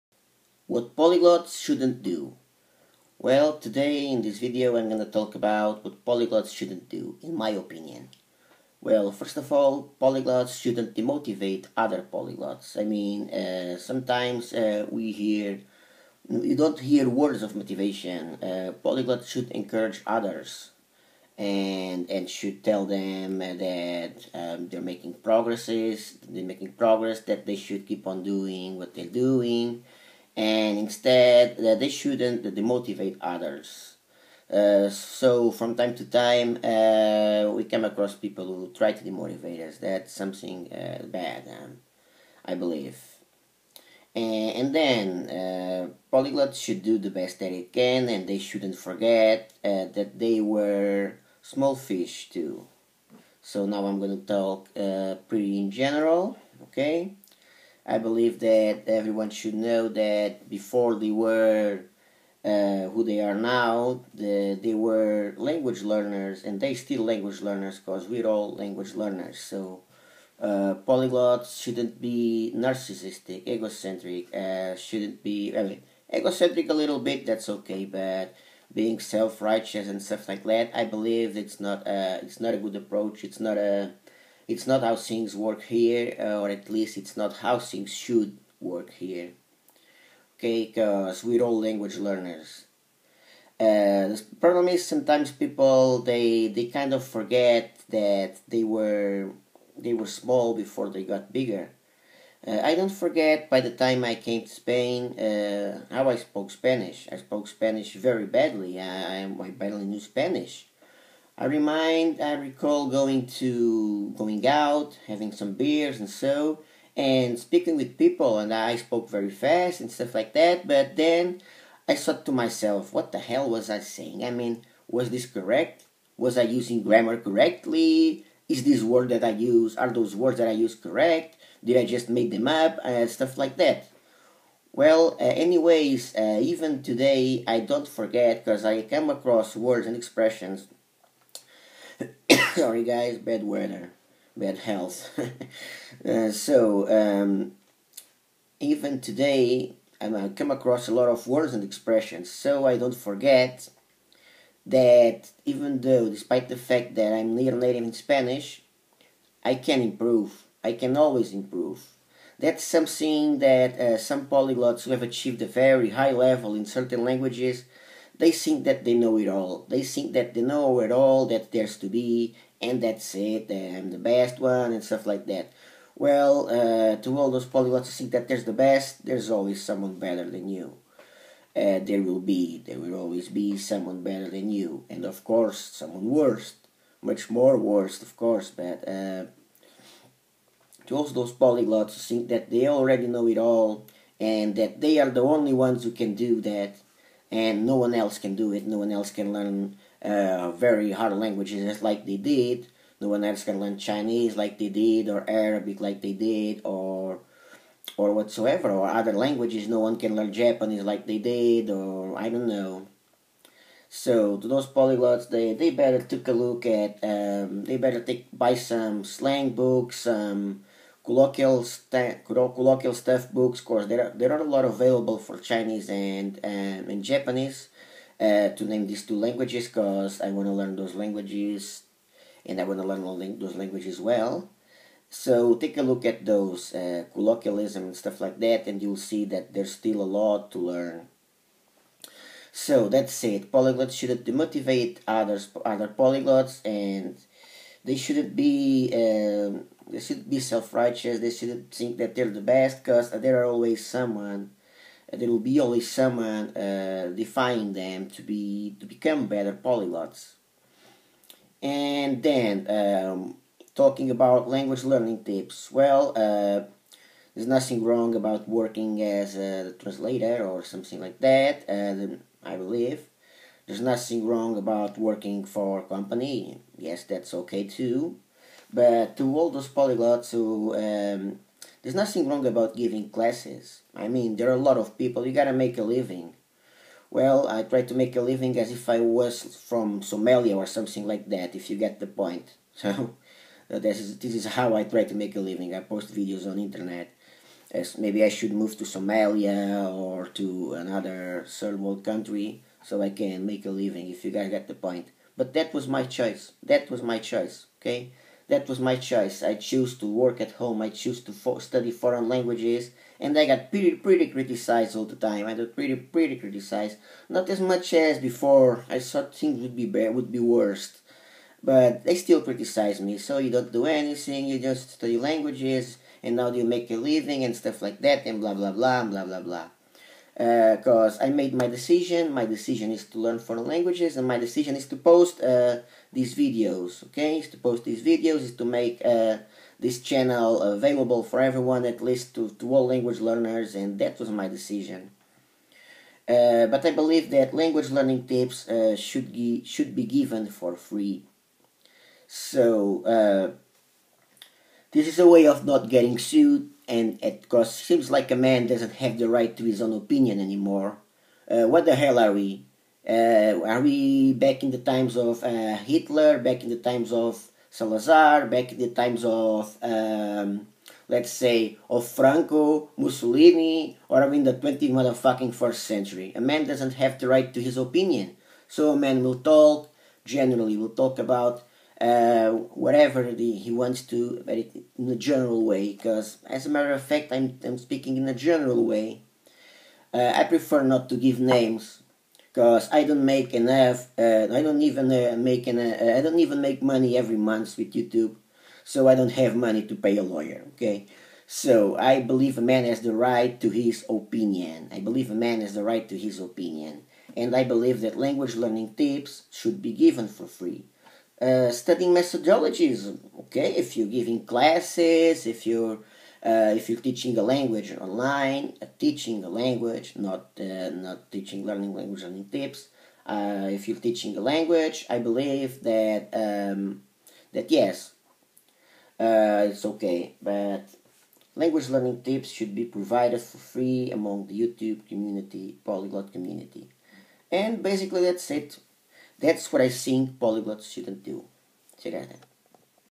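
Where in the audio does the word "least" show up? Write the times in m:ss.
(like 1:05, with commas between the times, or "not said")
1:26, 5:42.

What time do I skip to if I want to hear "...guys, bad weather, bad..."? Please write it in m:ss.
2:22.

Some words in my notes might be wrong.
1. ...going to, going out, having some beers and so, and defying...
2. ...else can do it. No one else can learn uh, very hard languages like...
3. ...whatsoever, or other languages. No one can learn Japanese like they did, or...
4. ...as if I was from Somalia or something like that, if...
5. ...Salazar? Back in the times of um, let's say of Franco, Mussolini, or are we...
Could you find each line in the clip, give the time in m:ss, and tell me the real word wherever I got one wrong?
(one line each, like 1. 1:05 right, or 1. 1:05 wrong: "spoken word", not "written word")
1. 1:52 wrong: "speaking", not "defying"
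2. 3:17 right
3. 3:28 right
4. 4:48 right
5. 6:07 right.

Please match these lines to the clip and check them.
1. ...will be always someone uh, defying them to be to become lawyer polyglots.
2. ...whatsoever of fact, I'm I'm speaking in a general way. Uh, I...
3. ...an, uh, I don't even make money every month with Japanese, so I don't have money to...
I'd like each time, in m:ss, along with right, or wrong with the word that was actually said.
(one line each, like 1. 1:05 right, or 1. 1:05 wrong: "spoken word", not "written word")
1. 4:15 wrong: "better", not "lawyer"
2. 6:26 wrong: "matter", not "whatsoever"
3. 6:35 wrong: "YouTube", not "Japanese".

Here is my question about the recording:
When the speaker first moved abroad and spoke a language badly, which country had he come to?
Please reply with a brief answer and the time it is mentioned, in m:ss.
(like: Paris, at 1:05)
Spain, at 1:44.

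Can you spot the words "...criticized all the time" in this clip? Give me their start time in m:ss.
5:14.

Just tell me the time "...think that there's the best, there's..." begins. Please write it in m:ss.
2:57.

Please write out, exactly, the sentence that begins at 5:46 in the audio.
Uh, but I believe that language learning tips uh, should be, should be given for free.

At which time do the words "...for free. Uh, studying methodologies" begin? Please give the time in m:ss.
6:50.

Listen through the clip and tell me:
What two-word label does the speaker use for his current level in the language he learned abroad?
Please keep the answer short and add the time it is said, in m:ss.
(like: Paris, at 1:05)
near native, at 2:37.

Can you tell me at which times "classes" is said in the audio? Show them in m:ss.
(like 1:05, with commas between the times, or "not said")
4:43, 6:54.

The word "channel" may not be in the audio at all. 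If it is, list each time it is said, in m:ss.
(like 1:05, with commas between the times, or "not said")
5:40.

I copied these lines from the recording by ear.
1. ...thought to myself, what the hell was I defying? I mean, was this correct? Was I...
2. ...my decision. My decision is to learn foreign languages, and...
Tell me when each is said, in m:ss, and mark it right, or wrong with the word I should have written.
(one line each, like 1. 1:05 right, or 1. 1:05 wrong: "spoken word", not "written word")
1. 2:01 wrong: "saying", not "defying"
2. 5:31 right.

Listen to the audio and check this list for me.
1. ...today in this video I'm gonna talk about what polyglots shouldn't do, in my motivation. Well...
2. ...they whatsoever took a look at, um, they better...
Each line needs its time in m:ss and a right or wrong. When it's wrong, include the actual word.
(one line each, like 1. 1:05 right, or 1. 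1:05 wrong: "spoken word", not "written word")
1. 0:03 wrong: "opinion", not "motivation"
2. 3:35 wrong: "better", not "whatsoever".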